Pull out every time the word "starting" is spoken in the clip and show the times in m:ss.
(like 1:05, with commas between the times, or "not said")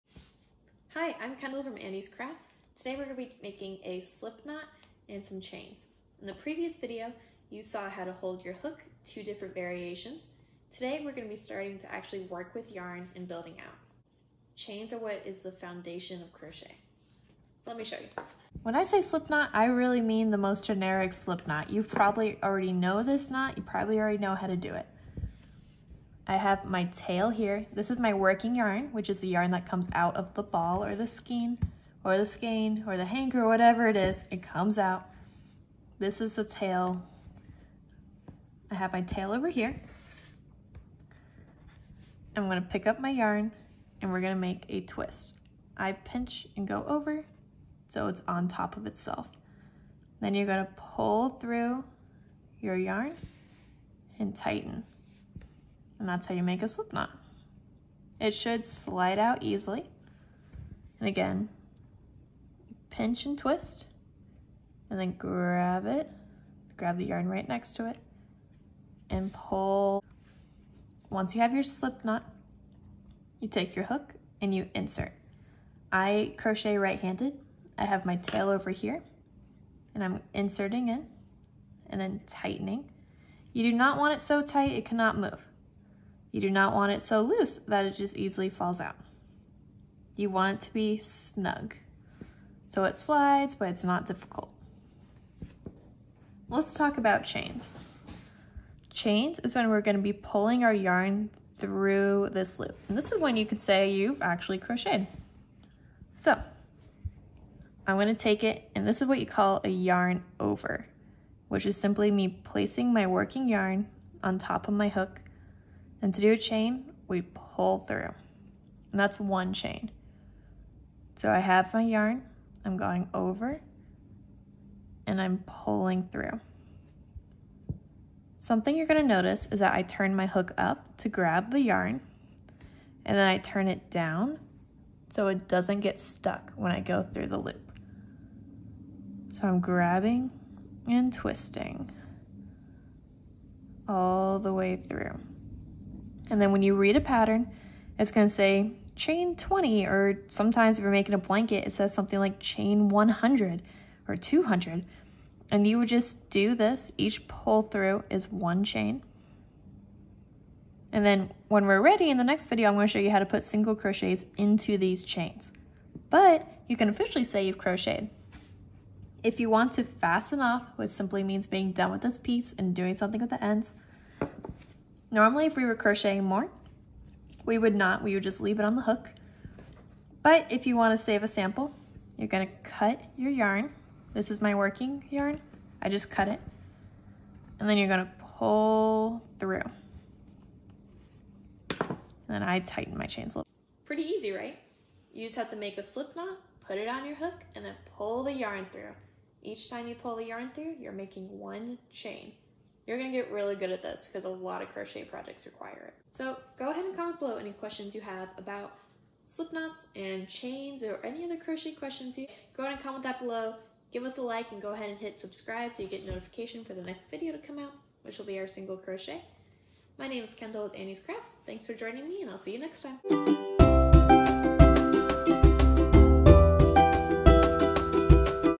0:11.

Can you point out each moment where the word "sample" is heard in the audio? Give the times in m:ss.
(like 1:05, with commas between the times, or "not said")
3:01.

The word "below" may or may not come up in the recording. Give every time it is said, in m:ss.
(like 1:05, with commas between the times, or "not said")
3:27, 3:33.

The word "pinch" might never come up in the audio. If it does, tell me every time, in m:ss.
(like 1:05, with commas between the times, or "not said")
0:45, 1:02.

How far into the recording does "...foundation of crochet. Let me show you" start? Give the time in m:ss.
0:15.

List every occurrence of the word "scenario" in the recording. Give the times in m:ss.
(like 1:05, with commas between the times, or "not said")
not said.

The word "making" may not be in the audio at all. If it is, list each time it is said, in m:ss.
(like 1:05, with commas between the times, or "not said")
0:03, 2:30, 3:20.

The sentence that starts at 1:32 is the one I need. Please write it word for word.
So it slides, but it's not difficult.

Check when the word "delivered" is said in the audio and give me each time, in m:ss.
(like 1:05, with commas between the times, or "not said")
not said.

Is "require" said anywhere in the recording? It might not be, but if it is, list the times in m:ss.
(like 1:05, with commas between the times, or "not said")
3:25.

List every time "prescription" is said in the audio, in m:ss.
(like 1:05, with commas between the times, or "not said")
not said.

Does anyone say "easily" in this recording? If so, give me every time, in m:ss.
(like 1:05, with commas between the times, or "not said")
0:59, 1:28.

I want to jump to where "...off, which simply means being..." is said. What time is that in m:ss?
2:50.